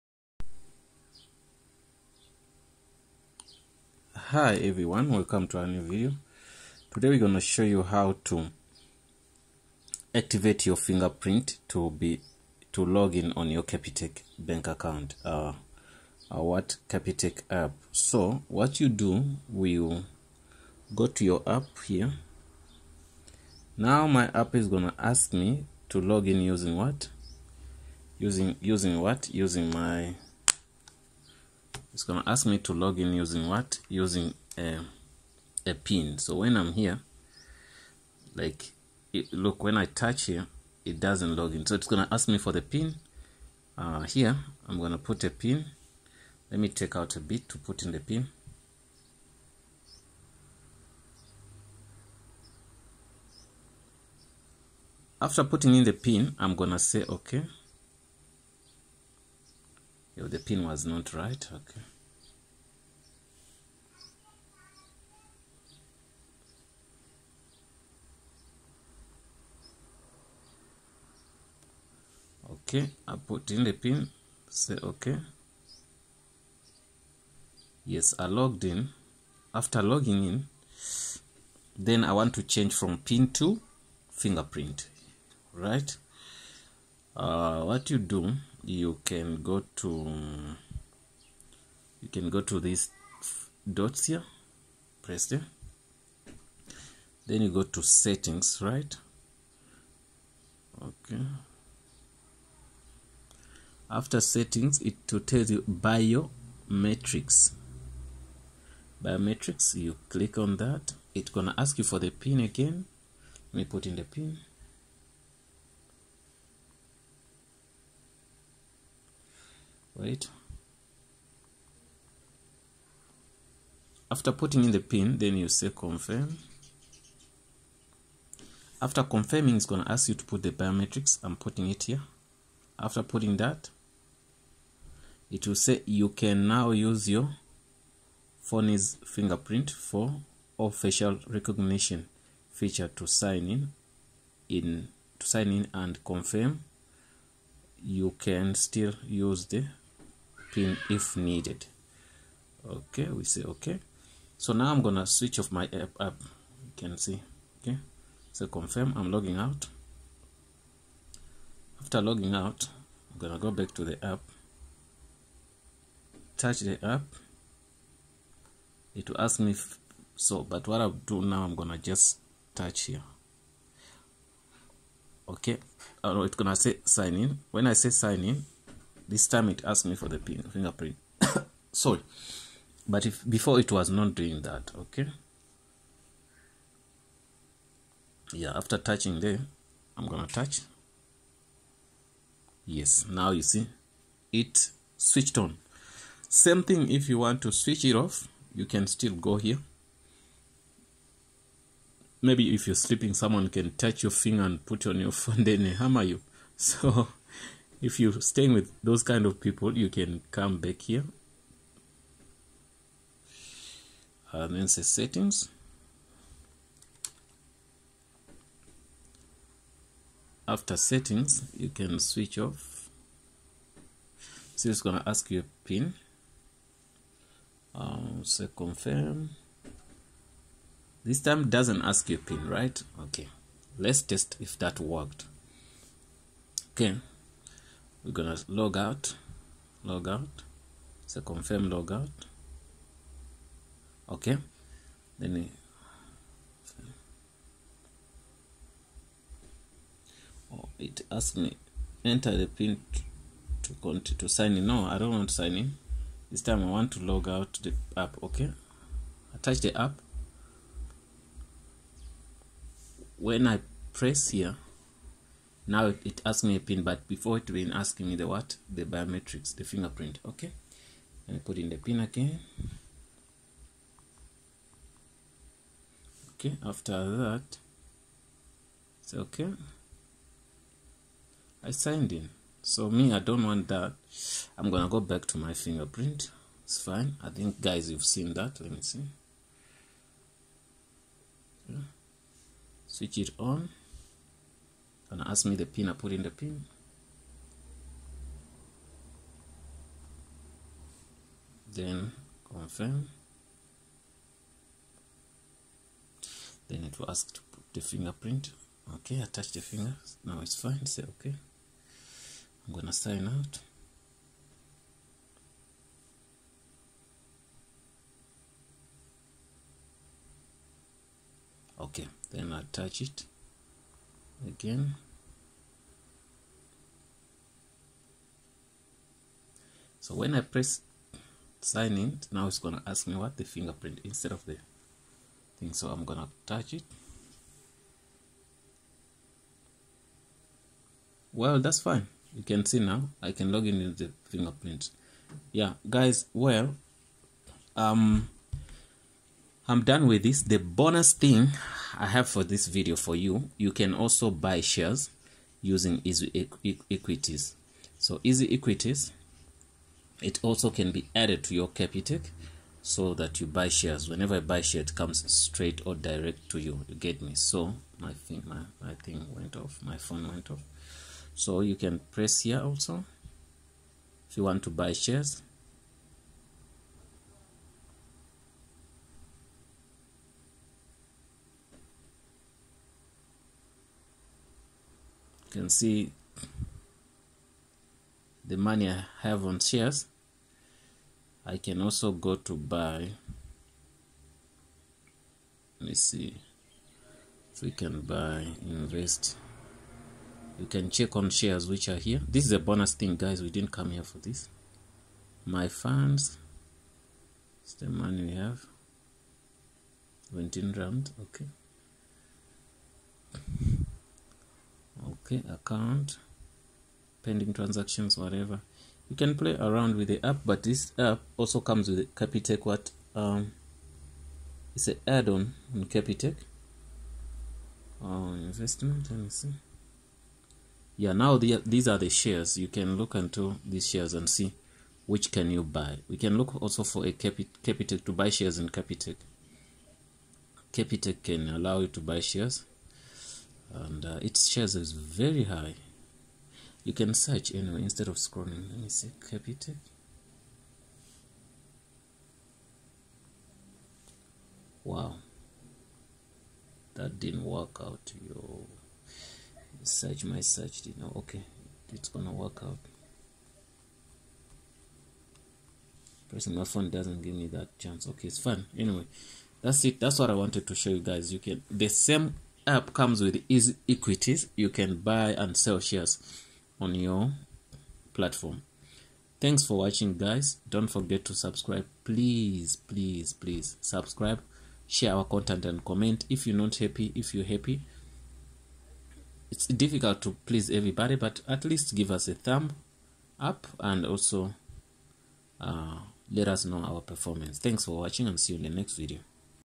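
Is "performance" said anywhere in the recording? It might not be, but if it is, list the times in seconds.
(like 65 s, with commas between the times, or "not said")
497 s.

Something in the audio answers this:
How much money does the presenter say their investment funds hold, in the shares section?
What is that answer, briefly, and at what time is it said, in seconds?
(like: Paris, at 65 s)
17 rand, at 410 s.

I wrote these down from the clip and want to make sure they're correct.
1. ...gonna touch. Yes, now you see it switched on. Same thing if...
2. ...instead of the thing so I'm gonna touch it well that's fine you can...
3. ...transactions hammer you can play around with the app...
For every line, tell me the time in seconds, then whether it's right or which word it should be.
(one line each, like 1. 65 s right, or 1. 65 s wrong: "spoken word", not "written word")
1. 190 s right
2. 334 s right
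3. 417 s wrong: "whatever", not "hammer".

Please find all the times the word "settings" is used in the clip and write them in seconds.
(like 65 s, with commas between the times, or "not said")
97 s, 104 s, 214 s, 220 s.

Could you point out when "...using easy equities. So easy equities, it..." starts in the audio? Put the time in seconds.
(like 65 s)
355 s.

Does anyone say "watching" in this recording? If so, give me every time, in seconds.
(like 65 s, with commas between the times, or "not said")
479 s, 497 s.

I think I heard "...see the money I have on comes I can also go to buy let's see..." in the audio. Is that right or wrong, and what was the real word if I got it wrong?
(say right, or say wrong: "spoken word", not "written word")
wrong: "shares", not "comes".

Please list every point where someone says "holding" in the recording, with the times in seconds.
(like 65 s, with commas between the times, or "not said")
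not said.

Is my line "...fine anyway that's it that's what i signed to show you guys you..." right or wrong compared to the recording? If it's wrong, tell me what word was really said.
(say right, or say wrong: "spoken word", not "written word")
wrong: "wanted", not "signed".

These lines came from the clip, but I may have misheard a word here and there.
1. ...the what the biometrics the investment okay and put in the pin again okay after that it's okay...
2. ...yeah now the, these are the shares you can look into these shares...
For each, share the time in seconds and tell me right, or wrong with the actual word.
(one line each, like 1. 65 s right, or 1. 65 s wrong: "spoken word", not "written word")
1. 268 s wrong: "fingerprint", not "investment"
2. 430 s right.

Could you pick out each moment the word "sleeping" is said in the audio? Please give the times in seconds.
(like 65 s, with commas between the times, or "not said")
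202 s.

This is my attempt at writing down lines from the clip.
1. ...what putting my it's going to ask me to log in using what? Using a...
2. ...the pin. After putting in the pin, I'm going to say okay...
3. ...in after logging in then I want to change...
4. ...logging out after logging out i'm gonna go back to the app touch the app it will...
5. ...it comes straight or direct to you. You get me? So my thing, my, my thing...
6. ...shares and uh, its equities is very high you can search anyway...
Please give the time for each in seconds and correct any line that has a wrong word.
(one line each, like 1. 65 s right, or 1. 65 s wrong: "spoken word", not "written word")
1. 29 s wrong: "using", not "putting"
2. 47 s right
3. 78 s right
4. 159 s right
5. 364 s right
6. 442 s wrong: "shares", not "equities".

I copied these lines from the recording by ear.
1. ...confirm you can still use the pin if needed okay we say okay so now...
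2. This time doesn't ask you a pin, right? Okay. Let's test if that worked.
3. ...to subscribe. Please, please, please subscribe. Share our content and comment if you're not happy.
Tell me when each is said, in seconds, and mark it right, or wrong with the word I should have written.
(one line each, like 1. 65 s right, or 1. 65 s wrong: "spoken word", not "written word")
1. 146 s right
2. 231 s right
3. 481 s right.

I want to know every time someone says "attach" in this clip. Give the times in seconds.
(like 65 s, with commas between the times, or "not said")
259 s, 309 s, 322 s.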